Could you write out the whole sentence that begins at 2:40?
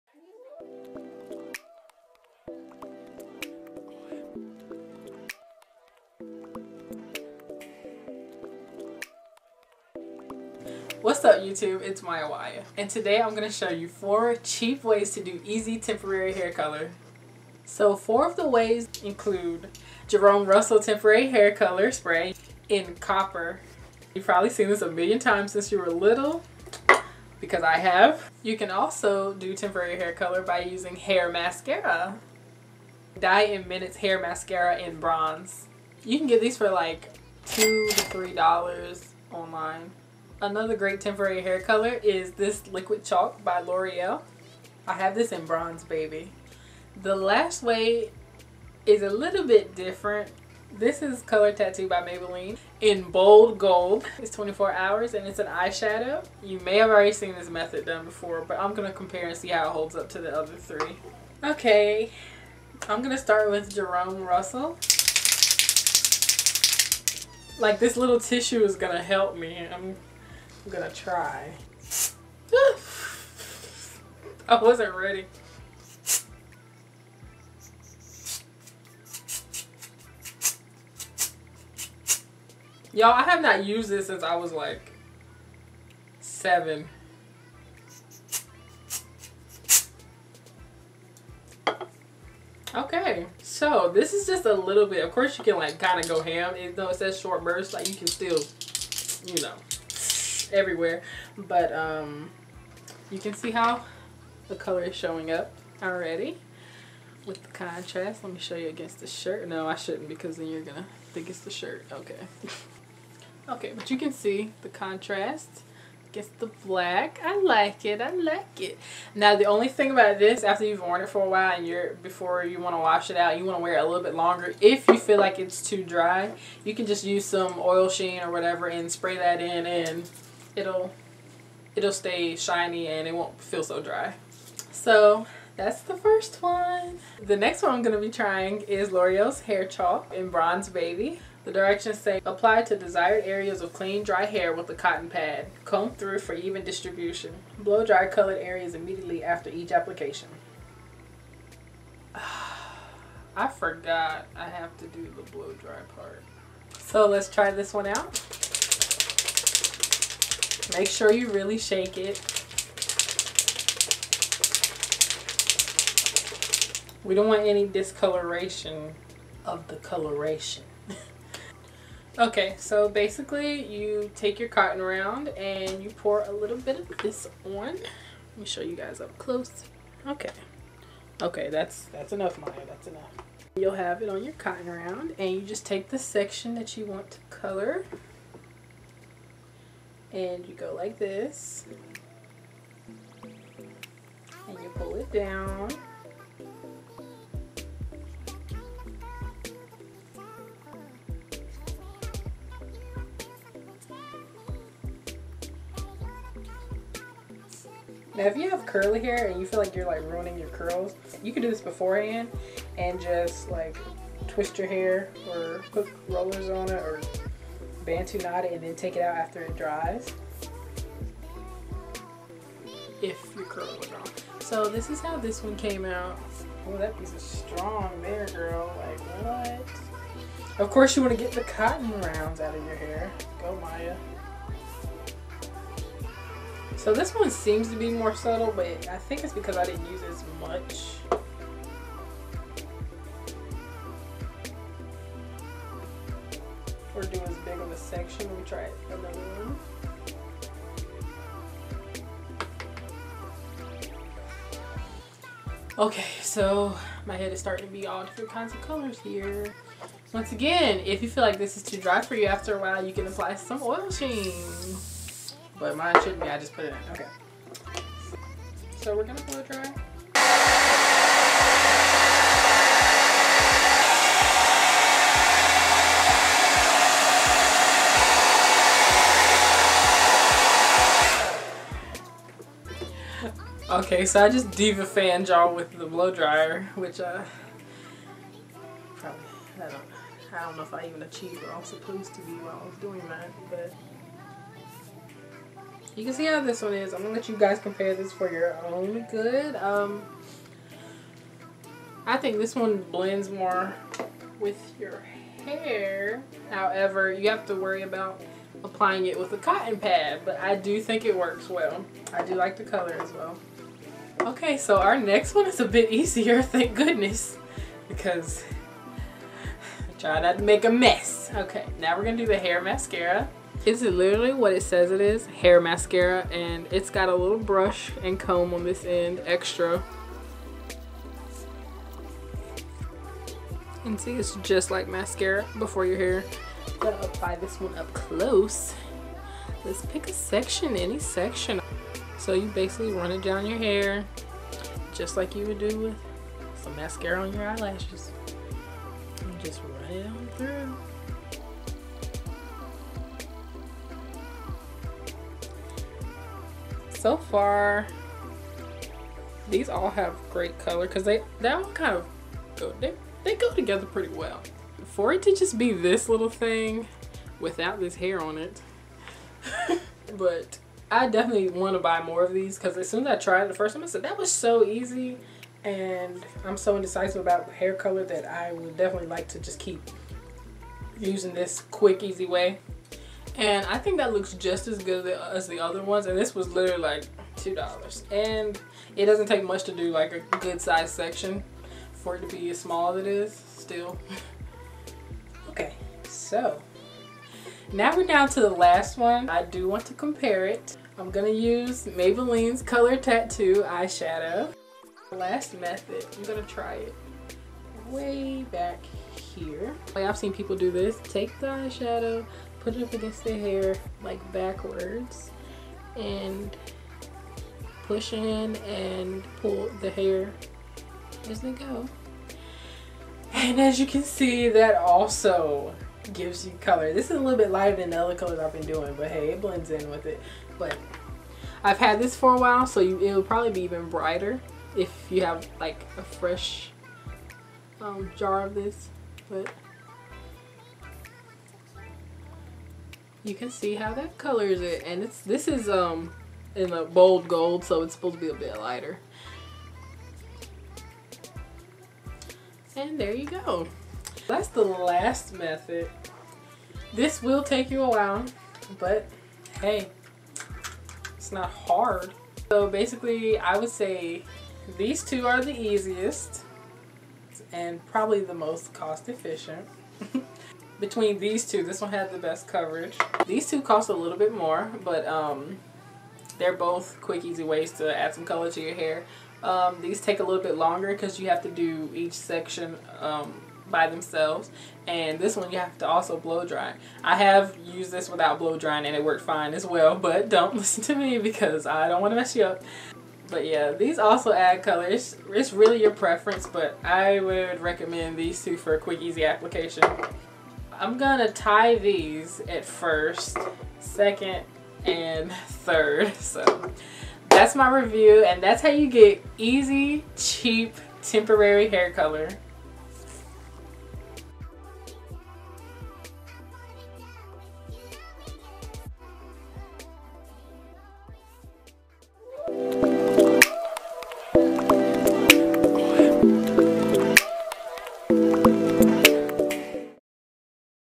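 Make sure you really shake it.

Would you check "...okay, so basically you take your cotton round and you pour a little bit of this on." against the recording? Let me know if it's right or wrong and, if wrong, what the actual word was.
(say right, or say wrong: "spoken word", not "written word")
right.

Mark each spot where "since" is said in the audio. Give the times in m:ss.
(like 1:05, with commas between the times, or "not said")
0:25, 1:24.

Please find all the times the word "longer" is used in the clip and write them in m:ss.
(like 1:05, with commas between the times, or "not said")
2:04, 8:00.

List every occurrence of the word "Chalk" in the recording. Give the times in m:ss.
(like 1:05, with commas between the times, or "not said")
0:43, 2:19.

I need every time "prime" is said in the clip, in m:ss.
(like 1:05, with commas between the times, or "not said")
not said.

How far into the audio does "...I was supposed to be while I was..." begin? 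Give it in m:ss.
4:51.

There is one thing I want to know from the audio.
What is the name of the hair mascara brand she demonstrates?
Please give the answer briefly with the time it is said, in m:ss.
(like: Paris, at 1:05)
Dye in Minutes, at 0:33.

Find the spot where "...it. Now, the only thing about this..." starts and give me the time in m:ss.
1:58.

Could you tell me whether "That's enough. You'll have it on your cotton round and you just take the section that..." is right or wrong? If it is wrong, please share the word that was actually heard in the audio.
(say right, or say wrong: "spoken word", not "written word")
right.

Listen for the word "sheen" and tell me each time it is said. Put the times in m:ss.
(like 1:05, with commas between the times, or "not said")
2:07, 4:23.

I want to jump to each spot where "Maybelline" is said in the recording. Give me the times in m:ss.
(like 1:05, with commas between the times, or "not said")
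0:52, 6:41.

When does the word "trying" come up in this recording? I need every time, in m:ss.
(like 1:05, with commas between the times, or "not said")
2:18.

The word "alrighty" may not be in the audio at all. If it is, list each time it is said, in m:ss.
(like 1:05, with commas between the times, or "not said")
not said.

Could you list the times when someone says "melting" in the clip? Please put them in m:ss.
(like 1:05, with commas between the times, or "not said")
not said.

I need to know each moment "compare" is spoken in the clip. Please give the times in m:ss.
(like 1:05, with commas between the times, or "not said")
0:58, 4:57, 6:39.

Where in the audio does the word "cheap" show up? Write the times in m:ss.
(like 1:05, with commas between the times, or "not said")
0:14, 8:30.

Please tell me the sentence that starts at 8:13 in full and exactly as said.
But yeah, these also add colors.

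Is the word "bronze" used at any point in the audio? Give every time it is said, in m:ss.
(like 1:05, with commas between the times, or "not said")
0:34, 0:45, 2:20.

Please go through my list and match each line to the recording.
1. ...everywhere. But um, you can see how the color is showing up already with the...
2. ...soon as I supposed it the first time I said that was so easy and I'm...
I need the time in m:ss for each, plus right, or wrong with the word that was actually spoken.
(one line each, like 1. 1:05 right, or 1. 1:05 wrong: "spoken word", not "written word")
1. 1:40 right
2. 6:12 wrong: "tried", not "supposed".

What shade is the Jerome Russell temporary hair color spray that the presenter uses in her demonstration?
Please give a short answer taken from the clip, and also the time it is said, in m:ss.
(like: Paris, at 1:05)
Copper, at 0:22.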